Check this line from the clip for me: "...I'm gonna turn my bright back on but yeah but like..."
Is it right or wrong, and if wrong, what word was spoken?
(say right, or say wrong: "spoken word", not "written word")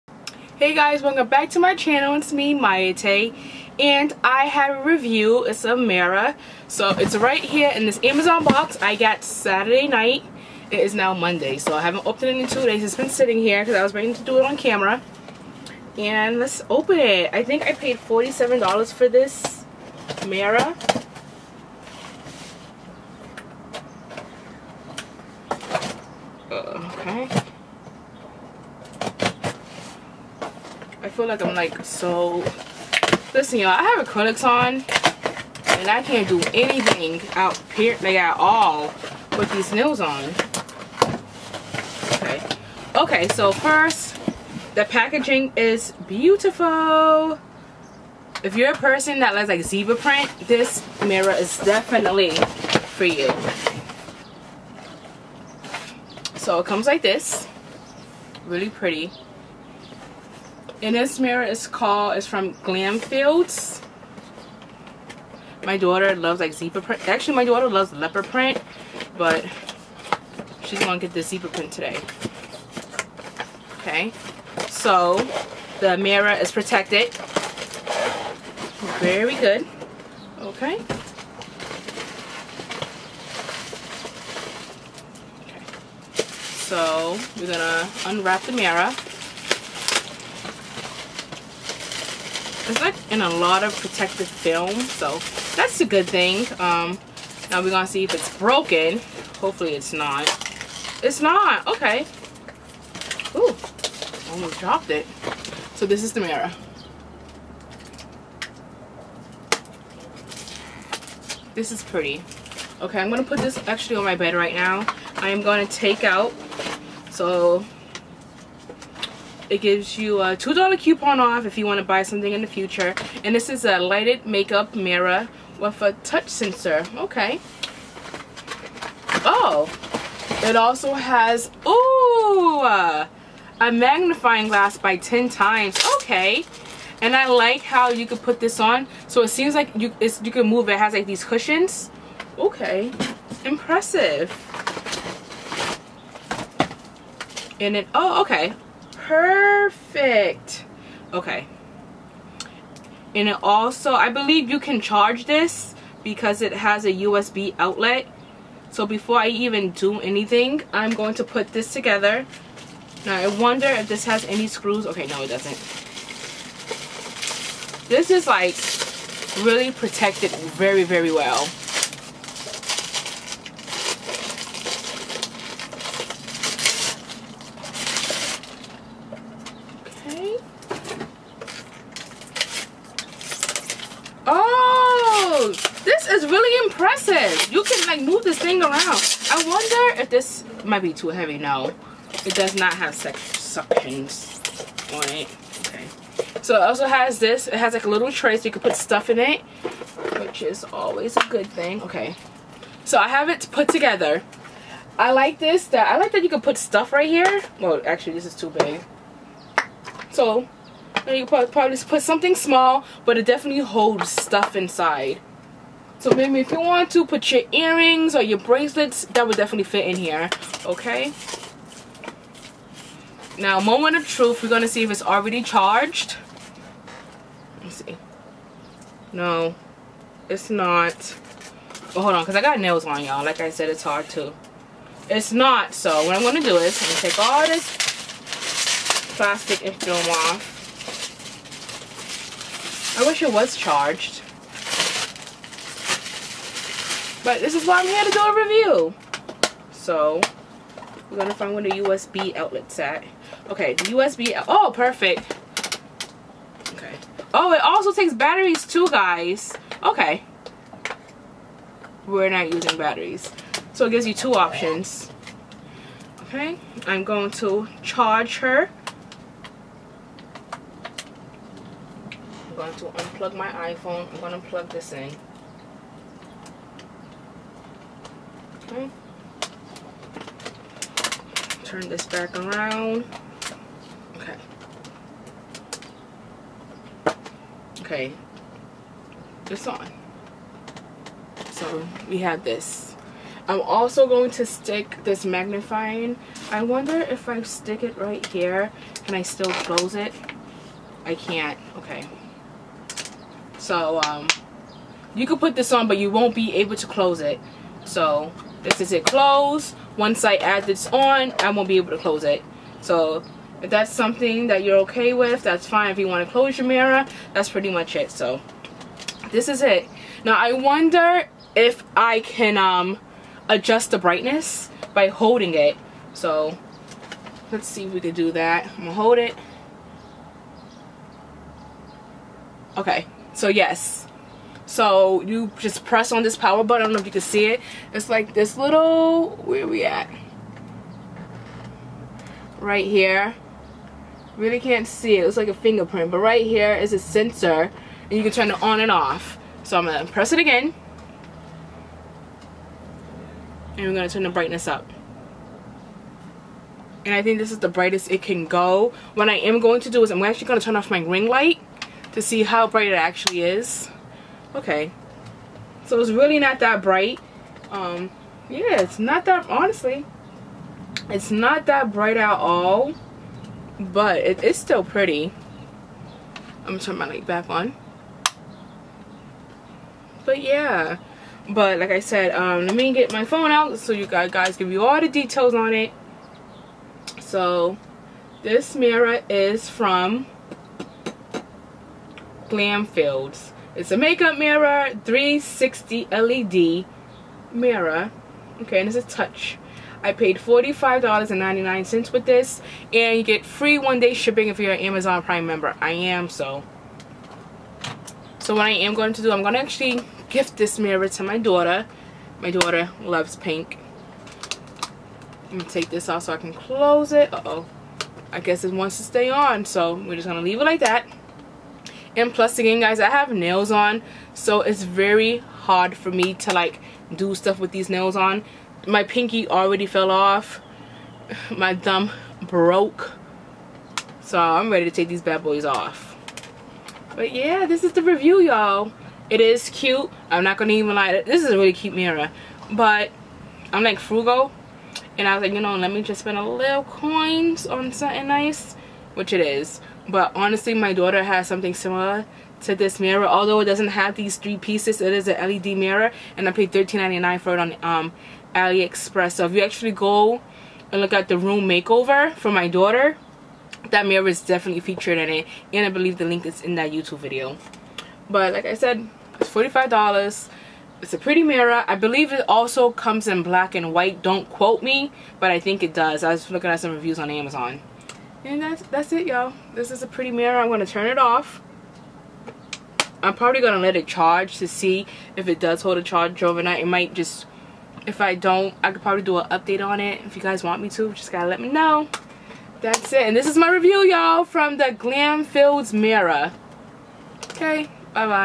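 wrong: "light", not "bright".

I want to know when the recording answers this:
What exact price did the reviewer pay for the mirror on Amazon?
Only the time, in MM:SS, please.
06:40.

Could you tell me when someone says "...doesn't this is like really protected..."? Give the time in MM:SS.
02:45.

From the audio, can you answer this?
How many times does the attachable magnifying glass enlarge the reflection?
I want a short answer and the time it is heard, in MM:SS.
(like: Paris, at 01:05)
10 times, at 02:14.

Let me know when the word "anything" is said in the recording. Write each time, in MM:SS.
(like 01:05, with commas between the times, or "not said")
00:36, 02:39.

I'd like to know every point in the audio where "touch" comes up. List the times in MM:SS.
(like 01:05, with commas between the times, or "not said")
02:06, 06:39.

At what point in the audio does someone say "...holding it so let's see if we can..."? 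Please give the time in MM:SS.
05:25.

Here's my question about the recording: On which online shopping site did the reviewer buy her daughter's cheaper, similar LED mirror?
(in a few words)
AliExpress.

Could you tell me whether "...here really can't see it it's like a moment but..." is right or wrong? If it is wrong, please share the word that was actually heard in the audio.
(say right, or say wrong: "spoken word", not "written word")
wrong: "fingerprint", not "moment".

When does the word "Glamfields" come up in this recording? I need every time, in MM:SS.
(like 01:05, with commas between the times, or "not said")
01:02, 06:32, 08:14.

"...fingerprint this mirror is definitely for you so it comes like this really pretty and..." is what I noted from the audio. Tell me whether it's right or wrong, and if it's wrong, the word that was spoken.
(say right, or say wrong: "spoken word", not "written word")
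wrong: "print", not "fingerprint".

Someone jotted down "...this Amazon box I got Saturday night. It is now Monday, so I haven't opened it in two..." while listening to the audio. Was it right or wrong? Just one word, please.
right.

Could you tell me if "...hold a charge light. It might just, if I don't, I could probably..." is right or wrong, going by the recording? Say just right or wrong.
wrong.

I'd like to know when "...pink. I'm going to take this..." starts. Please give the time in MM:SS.
06:53.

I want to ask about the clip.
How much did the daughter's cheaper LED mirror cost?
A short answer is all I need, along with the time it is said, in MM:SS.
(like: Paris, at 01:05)
$13.99, at 07:36.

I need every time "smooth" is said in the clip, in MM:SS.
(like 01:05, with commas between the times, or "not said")
not said.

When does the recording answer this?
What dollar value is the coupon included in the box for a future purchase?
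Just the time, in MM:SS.
02:00.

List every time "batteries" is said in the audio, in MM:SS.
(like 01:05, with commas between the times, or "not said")
04:18, 04:22.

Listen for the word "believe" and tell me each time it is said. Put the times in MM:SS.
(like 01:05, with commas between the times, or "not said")
02:34, 07:45, 07:51.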